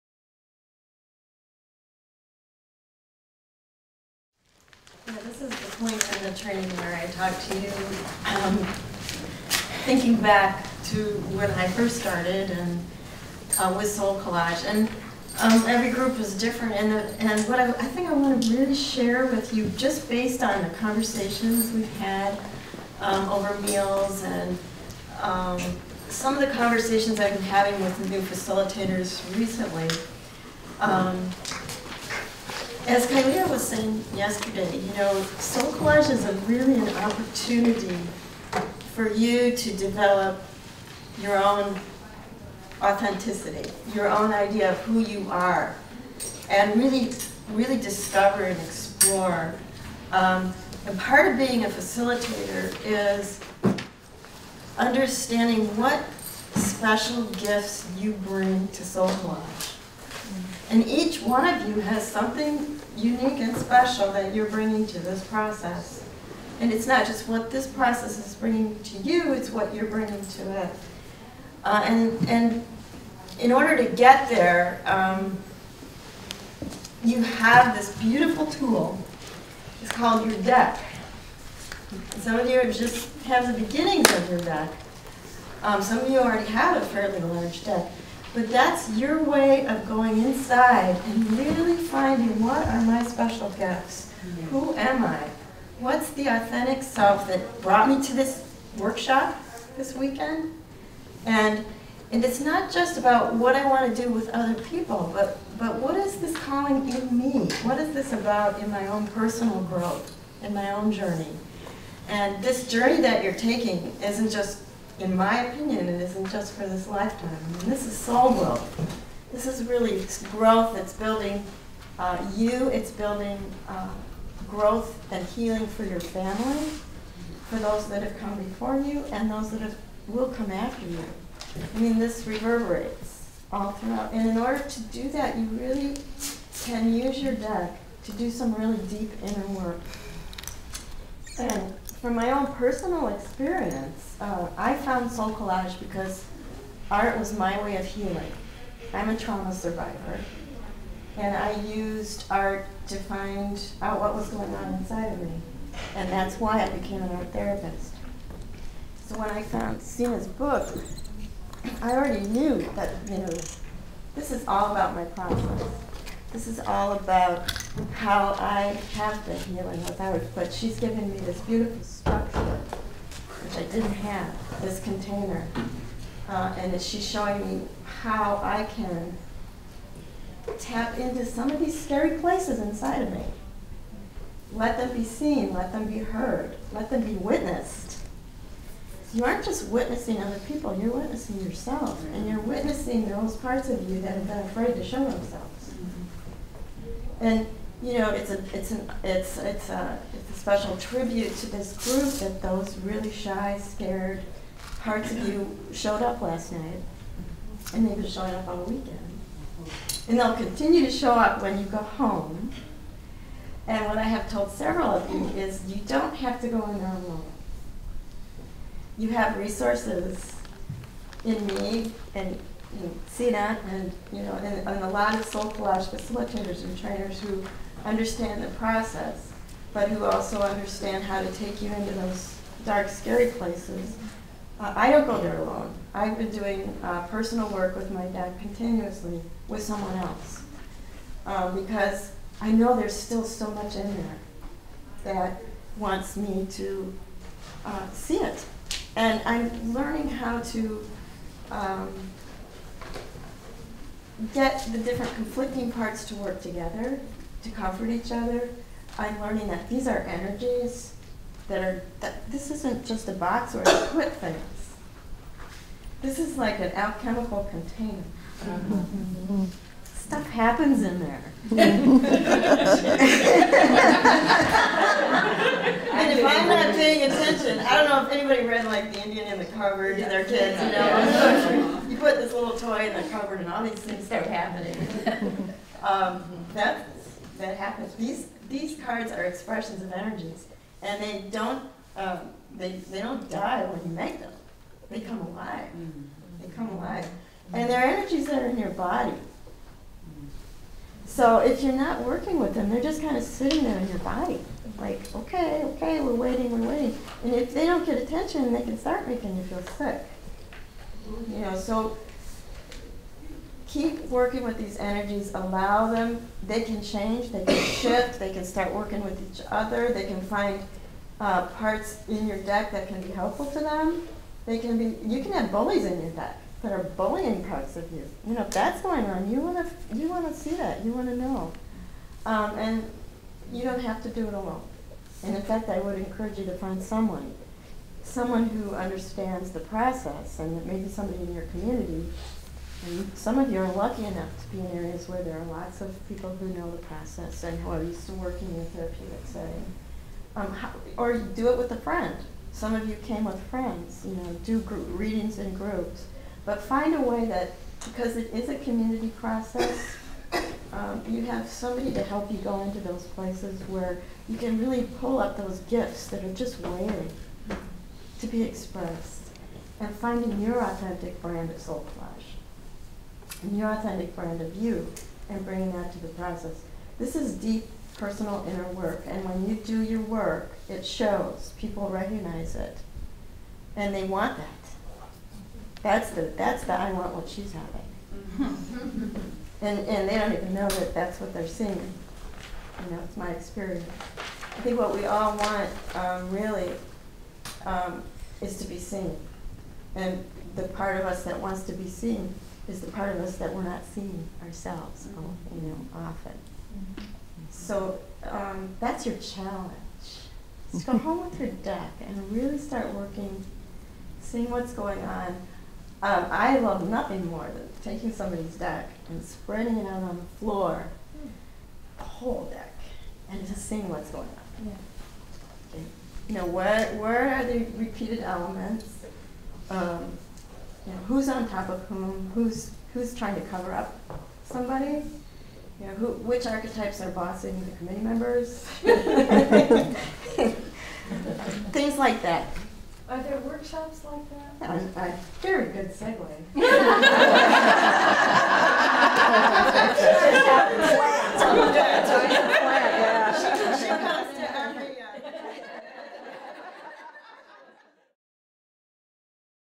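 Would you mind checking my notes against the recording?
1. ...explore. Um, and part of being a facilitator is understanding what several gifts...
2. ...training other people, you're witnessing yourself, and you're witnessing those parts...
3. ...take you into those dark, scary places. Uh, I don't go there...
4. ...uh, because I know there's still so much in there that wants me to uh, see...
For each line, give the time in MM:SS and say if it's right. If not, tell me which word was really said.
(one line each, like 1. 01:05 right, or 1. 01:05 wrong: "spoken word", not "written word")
1. 00:48 wrong: "special", not "several"
2. 03:09 wrong: "witnessing", not "training"
3. 03:51 right
4. 04:01 right.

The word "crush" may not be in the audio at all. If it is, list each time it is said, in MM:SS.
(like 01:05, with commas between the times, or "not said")
not said.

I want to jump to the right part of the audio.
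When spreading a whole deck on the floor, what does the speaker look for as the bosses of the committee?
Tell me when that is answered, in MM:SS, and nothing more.
07:16.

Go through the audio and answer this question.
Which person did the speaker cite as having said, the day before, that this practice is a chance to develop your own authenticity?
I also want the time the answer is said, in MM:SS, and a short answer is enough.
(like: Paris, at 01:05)
Kylea, at 00:33.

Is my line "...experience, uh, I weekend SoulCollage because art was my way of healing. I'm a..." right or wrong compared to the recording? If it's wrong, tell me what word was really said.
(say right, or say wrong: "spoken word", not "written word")
wrong: "found", not "weekend".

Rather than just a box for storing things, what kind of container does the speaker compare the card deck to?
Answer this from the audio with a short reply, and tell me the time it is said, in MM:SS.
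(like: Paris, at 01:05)
Alchemical container, at 04:26.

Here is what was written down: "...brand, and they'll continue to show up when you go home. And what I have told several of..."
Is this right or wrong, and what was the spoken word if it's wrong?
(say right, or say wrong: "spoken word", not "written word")
wrong: "weekend", not "brand".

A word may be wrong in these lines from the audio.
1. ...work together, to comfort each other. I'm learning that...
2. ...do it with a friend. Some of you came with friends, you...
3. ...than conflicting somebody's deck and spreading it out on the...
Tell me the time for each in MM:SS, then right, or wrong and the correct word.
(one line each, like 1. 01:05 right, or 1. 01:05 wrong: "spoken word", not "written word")
1. 04:16 right
2. 05:51 right
3. 06:57 wrong: "taking", not "conflicting".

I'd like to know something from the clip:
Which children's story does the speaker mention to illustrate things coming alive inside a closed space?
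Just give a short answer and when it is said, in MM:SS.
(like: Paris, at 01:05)
The Indian in the Cupboard, at 04:38.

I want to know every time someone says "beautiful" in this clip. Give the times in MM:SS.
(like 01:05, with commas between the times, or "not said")
01:17, 02:51.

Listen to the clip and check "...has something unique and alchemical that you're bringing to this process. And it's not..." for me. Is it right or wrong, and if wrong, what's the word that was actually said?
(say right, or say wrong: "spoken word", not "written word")
wrong: "special", not "alchemical".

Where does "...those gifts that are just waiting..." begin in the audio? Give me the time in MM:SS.
06:05.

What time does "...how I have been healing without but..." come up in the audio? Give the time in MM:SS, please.
02:47.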